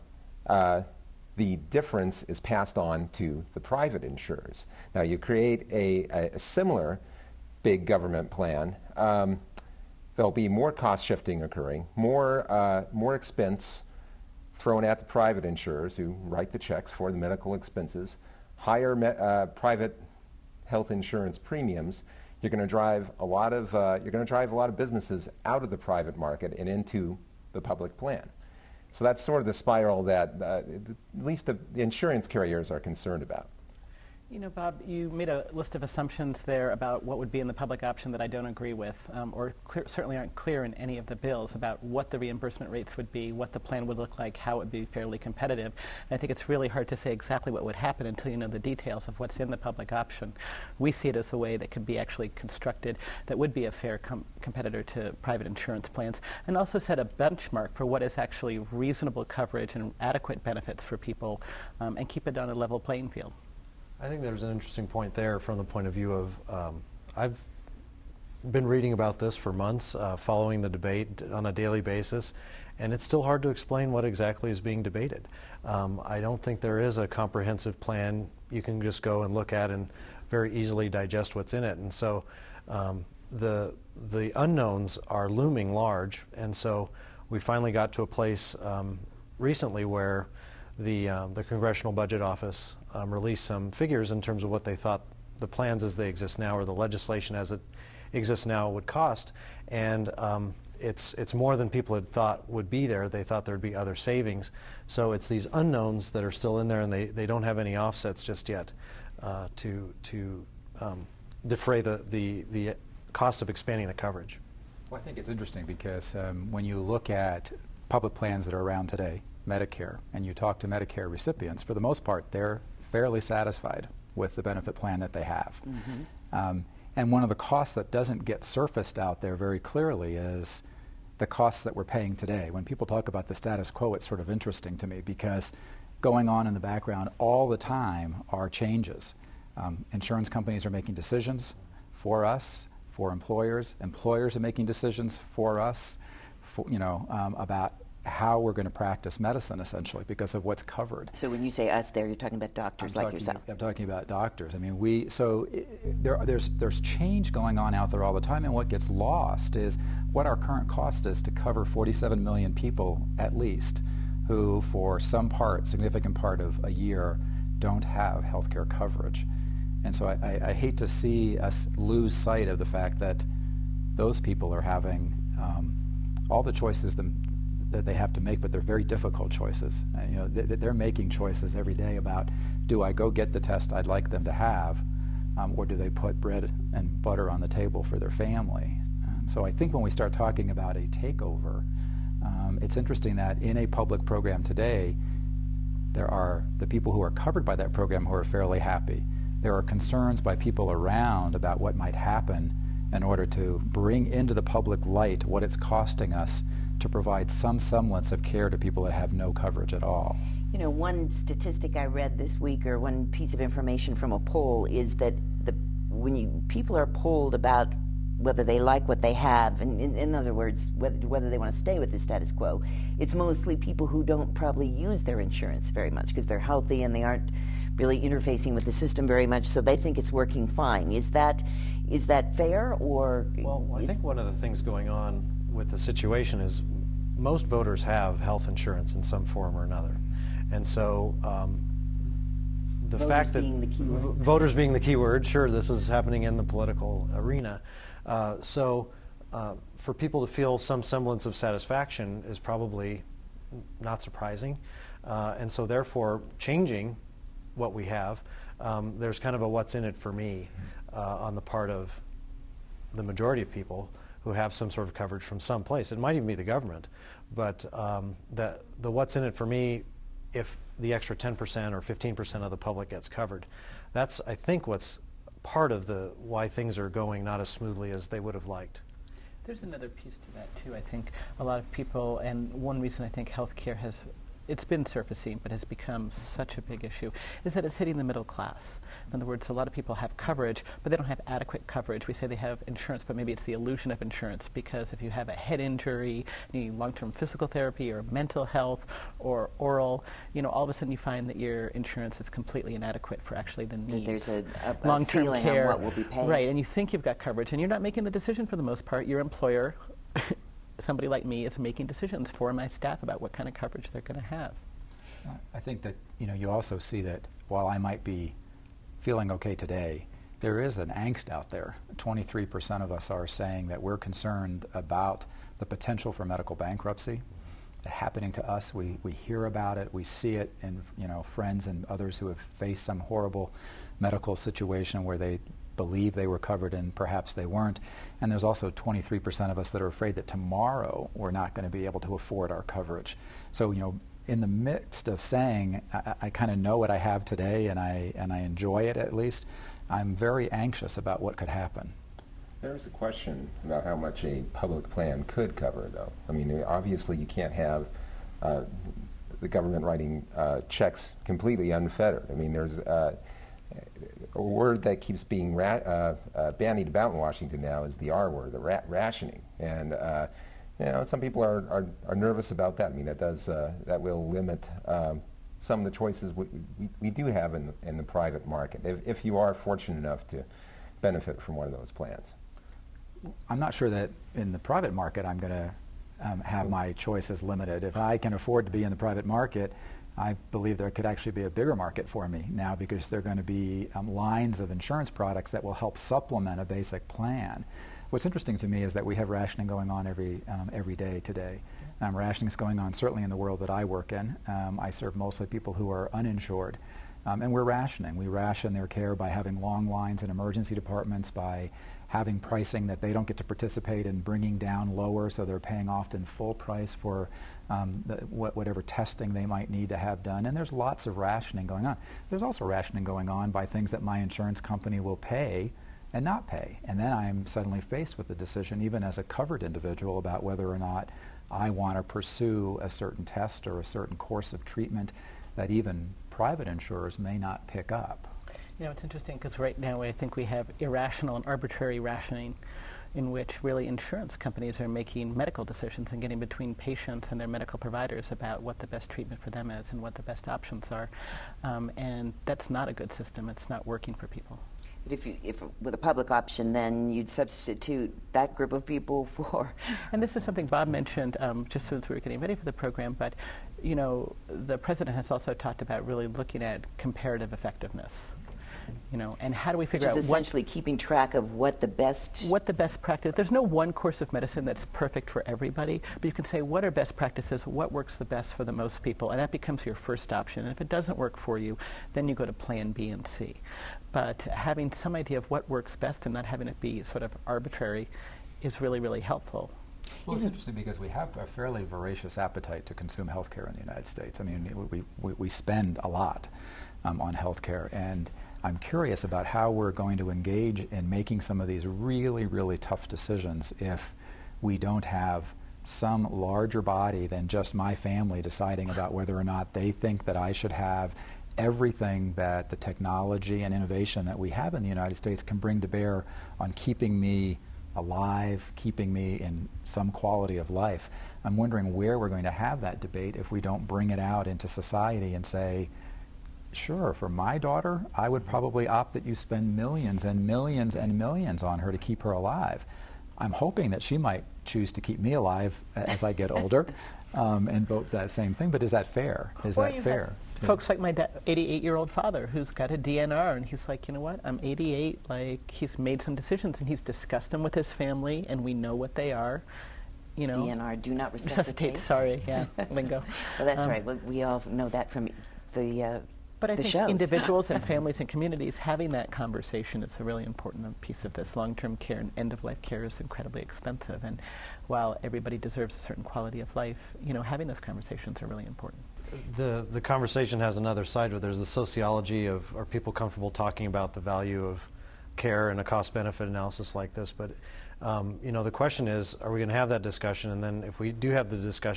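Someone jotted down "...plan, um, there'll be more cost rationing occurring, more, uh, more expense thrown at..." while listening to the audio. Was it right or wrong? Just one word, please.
wrong.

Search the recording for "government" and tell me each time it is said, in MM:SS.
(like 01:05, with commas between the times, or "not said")
00:07, 04:26, 05:59.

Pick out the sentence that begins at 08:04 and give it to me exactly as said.
But having some idea of what works best and not having it be sort of arbitrary is really really helpful.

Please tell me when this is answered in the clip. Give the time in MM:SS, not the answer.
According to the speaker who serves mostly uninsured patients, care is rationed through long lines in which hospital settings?
06:50.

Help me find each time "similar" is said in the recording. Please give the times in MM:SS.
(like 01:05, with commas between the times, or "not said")
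00:06.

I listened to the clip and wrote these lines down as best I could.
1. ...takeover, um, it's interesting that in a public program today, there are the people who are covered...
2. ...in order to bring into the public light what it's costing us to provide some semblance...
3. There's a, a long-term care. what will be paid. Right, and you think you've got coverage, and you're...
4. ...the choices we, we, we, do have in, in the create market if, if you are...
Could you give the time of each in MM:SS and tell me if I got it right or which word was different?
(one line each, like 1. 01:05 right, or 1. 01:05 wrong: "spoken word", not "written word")
1. 03:10 right
2. 03:22 right
3. 05:04 right
4. 06:15 wrong: "private", not "create".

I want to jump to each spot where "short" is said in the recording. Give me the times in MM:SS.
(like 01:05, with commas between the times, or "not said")
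not said.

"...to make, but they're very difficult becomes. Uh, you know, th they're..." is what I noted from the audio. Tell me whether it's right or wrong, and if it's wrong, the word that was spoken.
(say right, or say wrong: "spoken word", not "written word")
wrong: "choices", not "becomes".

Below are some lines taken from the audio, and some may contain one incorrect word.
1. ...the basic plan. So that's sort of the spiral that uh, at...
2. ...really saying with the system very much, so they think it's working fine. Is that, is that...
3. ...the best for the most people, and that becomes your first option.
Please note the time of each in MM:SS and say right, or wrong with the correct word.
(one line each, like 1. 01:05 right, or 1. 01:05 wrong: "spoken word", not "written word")
1. 00:27 wrong: "public", not "basic"
2. 03:47 wrong: "interfacing", not "saying"
3. 07:58 right.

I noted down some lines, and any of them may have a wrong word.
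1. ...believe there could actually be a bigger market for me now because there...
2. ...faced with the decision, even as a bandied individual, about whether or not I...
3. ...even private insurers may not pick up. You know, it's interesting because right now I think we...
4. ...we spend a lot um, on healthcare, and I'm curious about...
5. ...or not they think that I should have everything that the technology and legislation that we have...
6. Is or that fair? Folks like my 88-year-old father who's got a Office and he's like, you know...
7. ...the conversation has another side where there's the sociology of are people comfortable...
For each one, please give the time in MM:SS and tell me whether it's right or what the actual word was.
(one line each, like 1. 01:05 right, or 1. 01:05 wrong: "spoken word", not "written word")
1. 06:30 right
2. 07:07 wrong: "covered", not "bandied"
3. 07:15 right
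4. 08:15 right
5. 08:29 wrong: "innovation", not "legislation"
6. 08:59 wrong: "DNR", not "Office"
7. 09:29 right.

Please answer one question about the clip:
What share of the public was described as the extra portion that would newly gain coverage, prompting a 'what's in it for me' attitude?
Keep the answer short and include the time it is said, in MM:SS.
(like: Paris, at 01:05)
10% or 15%, at 04:31.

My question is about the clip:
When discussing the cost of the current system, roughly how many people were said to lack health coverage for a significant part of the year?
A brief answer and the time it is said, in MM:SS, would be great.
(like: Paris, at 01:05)
47 million, at 02:41.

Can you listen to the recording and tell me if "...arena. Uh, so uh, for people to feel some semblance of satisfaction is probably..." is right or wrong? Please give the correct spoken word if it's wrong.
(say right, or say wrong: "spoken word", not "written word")
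right.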